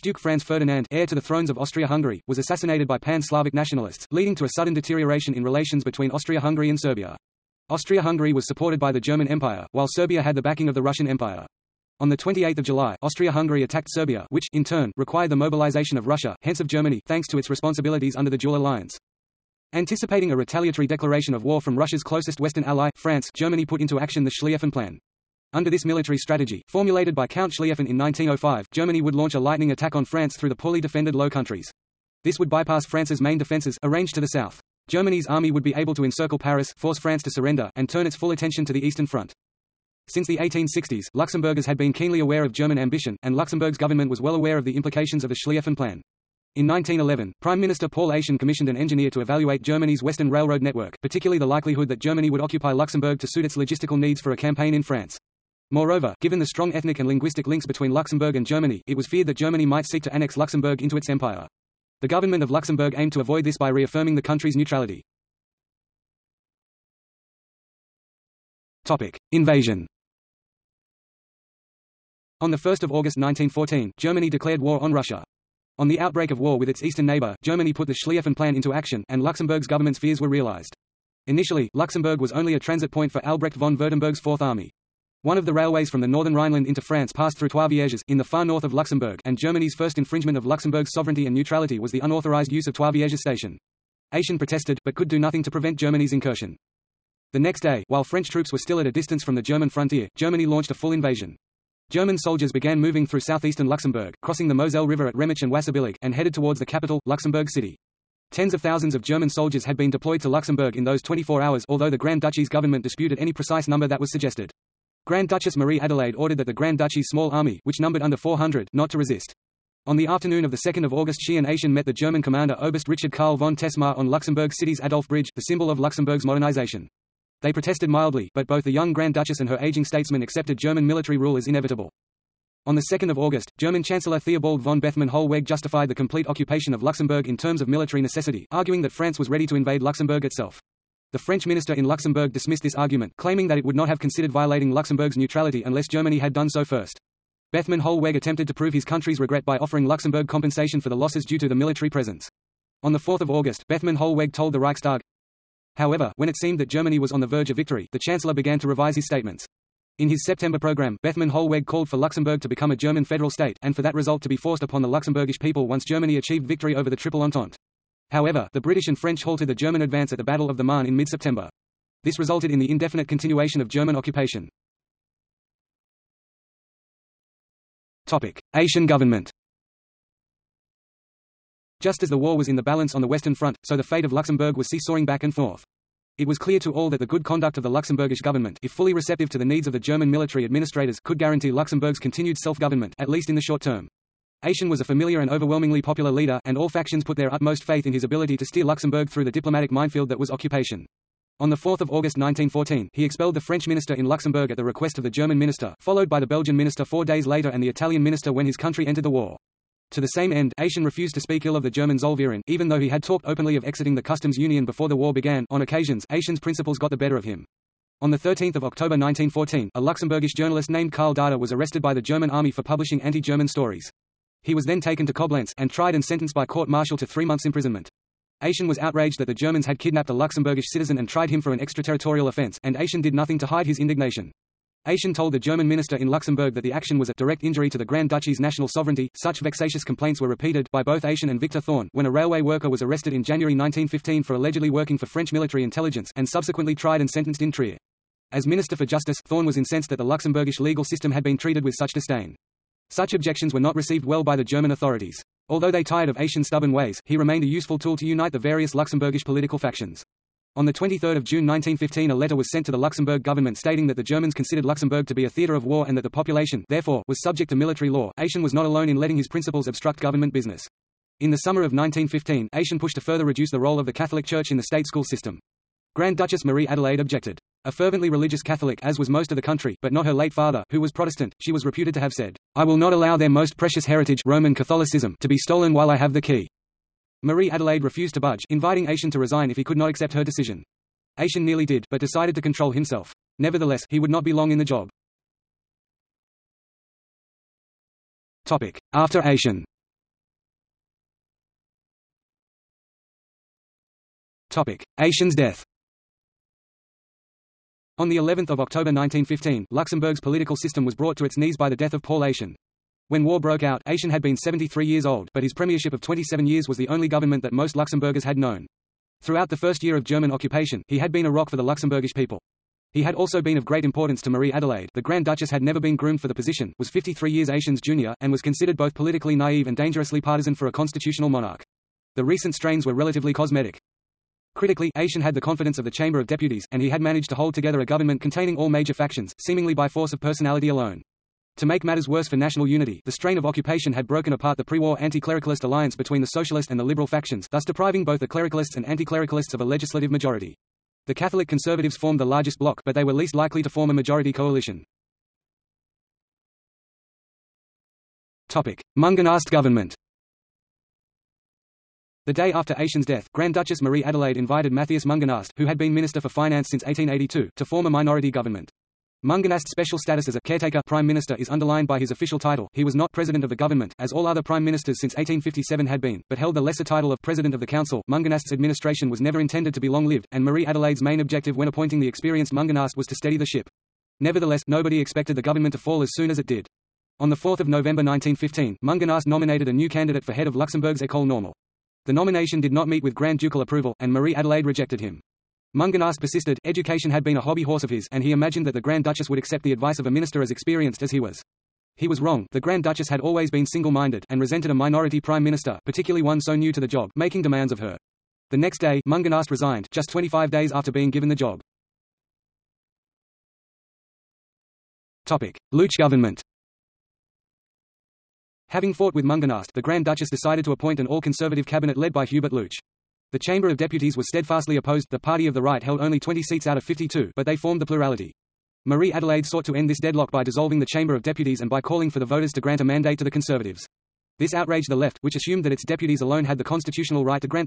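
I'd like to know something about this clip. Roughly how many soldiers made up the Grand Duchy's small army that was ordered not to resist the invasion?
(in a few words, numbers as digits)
under 400.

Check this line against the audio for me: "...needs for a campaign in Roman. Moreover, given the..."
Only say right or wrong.
wrong.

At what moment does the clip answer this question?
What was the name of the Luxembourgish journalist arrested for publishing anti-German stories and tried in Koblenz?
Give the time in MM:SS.
03:40.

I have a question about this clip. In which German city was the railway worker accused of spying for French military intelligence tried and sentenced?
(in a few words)
Trier.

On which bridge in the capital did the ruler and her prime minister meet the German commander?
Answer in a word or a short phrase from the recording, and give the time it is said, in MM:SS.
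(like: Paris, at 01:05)
Adolf Bridge, at 02:04.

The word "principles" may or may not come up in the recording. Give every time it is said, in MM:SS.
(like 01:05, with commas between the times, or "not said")
03:36, 04:29.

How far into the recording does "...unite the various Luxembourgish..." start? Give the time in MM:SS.
04:18.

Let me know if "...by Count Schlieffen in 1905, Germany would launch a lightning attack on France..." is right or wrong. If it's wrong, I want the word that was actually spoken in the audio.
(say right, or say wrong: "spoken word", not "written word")
right.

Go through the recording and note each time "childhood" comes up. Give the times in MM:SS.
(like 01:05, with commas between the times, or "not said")
not said.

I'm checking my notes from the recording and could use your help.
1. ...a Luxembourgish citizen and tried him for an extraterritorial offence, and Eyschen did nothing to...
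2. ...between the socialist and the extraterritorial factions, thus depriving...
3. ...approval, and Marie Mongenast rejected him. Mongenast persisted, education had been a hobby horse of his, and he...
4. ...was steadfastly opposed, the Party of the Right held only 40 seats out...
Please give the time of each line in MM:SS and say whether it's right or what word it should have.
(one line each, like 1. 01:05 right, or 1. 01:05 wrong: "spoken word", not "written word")
1. 03:50 right
2. 05:45 wrong: "liberal", not "extraterritorial"
3. 06:33 wrong: "Adelaide", not "Mongenast"
4. 07:04 wrong: "20", not "40".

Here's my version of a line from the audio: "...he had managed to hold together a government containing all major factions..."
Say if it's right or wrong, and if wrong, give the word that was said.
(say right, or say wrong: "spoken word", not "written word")
right.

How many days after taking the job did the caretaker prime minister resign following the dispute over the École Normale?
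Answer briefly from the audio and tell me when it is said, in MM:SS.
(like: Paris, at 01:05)
25, at 06:50.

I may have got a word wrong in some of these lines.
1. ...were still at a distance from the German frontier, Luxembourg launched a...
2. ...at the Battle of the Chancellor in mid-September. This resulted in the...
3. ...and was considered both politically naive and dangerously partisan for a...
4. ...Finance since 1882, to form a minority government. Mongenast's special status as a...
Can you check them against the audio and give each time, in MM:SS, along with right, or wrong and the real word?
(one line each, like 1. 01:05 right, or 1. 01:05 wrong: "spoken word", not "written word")
1. 01:38 wrong: "Germany", not "Luxembourg"
2. 02:50 wrong: "Marne", not "Chancellor"
3. 05:28 right
4. 06:06 right.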